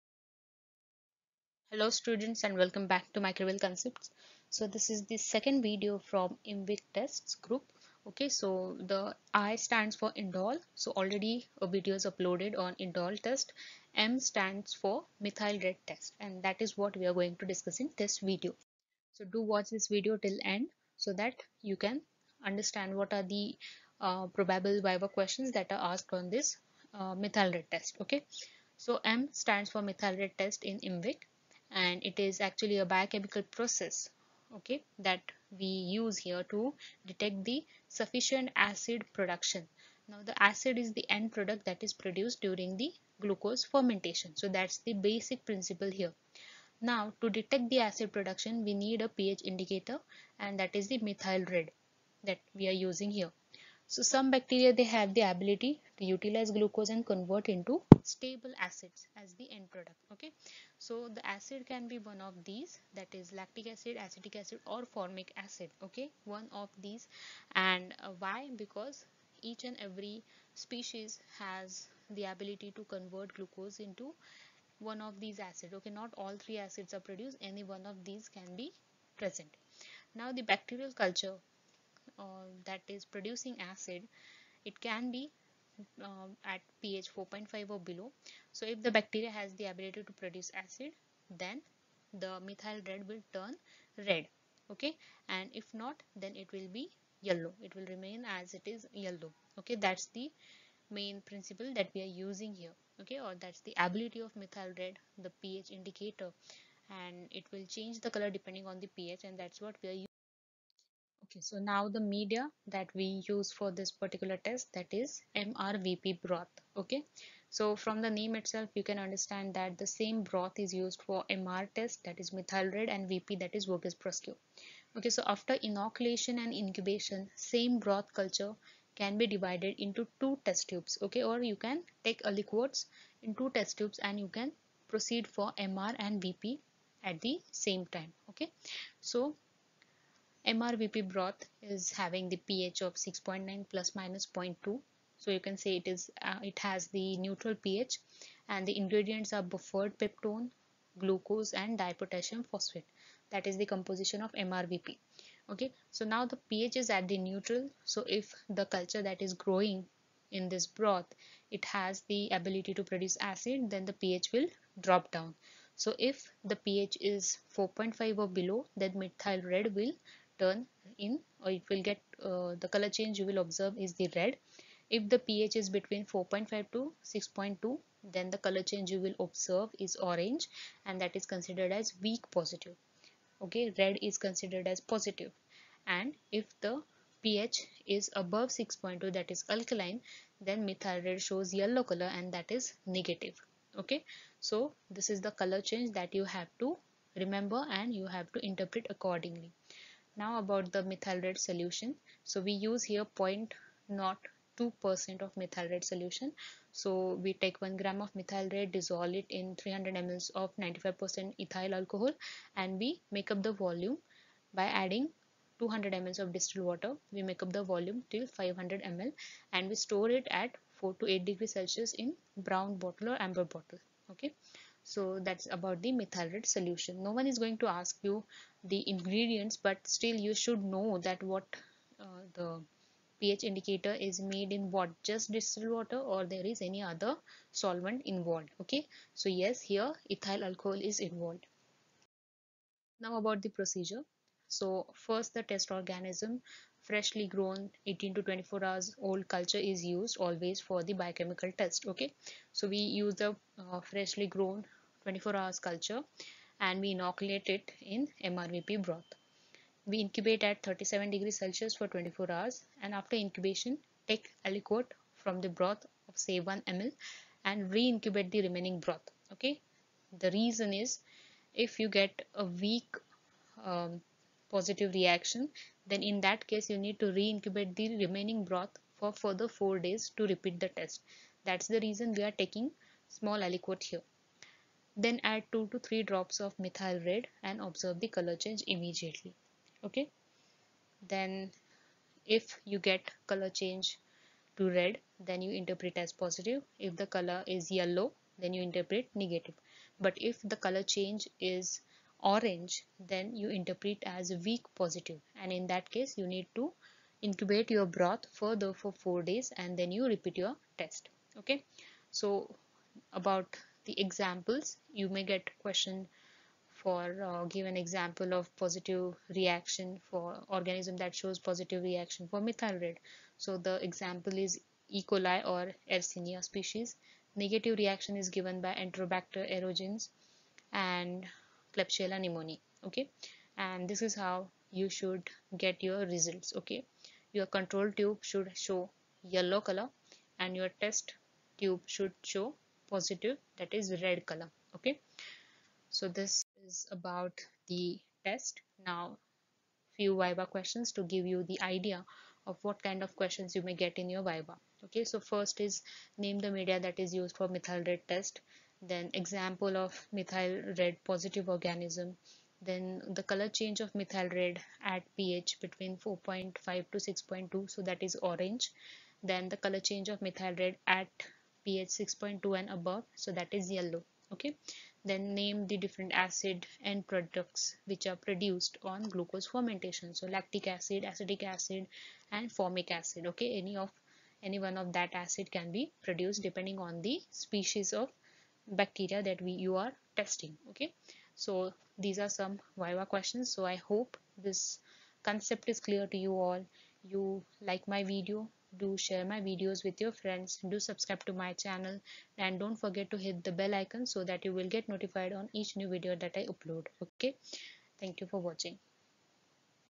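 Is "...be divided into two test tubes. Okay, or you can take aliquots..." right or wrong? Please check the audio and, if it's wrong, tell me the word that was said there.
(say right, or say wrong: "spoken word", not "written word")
right.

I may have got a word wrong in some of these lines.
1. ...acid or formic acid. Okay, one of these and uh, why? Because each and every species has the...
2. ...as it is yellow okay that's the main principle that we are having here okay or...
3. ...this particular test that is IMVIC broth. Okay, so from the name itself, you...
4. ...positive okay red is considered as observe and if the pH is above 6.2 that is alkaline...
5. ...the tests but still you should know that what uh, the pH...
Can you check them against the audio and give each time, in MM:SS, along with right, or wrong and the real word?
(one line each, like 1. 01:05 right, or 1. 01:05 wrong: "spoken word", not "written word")
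1. 01:04 right
2. 01:38 wrong: "using", not "having"
3. 01:53 wrong: "MRVP", not "IMVIC"
4. 03:02 wrong: "positive", not "observe"
5. 03:48 wrong: "ingredients", not "tests".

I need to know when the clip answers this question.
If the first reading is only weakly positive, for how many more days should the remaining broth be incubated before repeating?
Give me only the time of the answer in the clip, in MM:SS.
04:39.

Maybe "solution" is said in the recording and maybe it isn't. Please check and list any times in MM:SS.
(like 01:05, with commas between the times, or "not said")
03:21, 03:25, 03:46.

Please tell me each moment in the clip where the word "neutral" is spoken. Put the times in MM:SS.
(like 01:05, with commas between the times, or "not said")
02:27, 02:37.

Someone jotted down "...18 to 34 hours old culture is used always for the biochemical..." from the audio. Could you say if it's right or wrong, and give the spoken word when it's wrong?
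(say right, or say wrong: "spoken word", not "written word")
wrong: "24", not "34".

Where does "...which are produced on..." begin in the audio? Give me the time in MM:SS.
06:17.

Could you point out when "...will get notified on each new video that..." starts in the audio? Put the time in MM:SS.
06:44.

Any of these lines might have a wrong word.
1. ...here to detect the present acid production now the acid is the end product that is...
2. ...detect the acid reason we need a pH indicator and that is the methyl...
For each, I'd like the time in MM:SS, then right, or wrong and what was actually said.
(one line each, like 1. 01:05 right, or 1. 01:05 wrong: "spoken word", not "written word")
1. 00:36 wrong: "sufficient", not "present"
2. 00:47 wrong: "production", not "reason".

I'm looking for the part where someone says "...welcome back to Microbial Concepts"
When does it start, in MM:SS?
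00:02.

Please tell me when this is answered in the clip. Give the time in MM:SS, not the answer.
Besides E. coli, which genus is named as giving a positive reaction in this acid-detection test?
05:25.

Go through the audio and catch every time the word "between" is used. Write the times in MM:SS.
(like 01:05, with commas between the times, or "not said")
02:55, 06:05.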